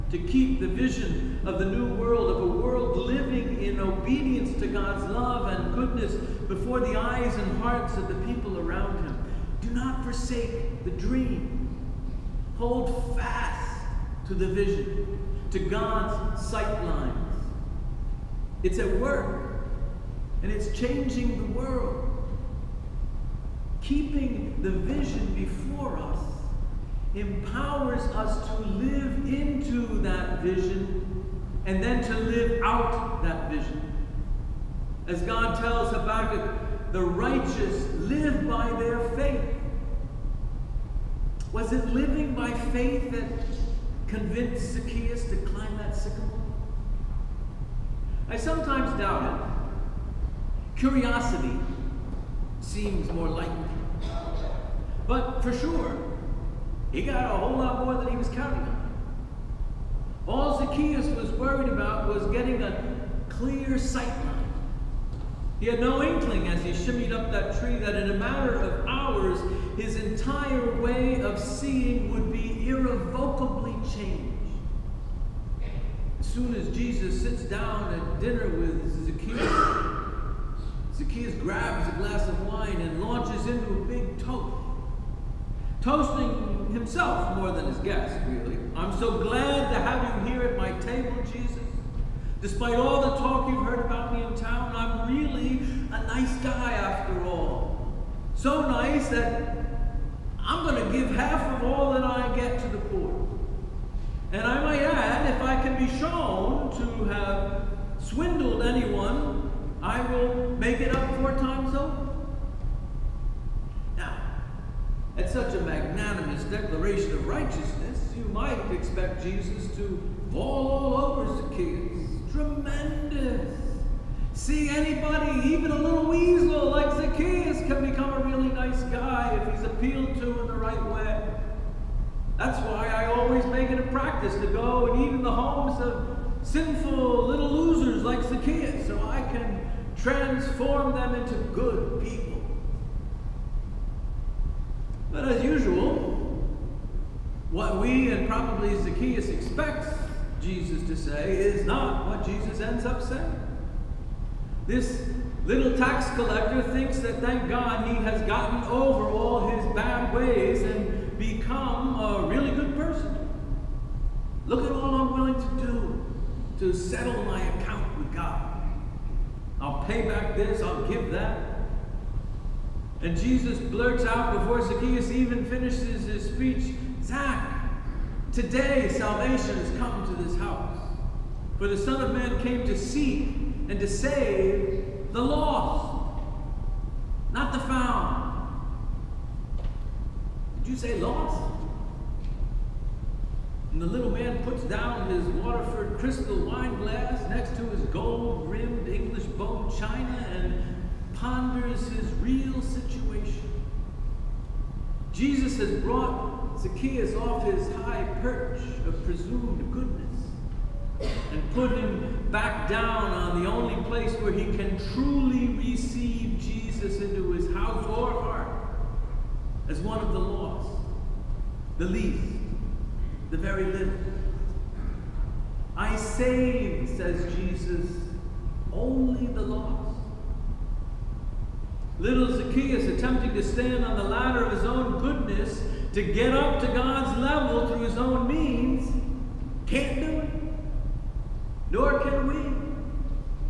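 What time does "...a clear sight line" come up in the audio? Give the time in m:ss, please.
1:02.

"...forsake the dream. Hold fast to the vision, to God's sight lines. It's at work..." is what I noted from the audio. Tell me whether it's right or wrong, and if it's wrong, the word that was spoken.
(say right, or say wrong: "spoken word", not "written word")
right.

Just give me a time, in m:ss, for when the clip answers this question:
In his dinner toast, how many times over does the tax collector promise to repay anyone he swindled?
1:51.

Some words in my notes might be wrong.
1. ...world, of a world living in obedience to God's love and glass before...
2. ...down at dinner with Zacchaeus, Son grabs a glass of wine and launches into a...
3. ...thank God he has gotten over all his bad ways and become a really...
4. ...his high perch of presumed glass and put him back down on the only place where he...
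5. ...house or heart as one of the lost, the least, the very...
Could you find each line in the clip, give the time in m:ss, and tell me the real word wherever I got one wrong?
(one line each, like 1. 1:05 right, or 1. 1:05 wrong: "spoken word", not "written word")
1. 0:01 wrong: "goodness", not "glass"
2. 1:17 wrong: "Zacchaeus", not "Son"
3. 2:37 right
4. 3:27 wrong: "goodness", not "glass"
5. 3:37 right.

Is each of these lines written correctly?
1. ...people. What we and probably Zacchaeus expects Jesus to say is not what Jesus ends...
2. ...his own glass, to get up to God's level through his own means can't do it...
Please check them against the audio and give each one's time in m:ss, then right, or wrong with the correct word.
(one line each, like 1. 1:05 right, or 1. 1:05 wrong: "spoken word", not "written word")
1. 2:22 right
2. 3:54 wrong: "goodness", not "glass".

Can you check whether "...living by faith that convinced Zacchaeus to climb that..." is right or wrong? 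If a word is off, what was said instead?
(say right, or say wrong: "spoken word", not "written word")
right.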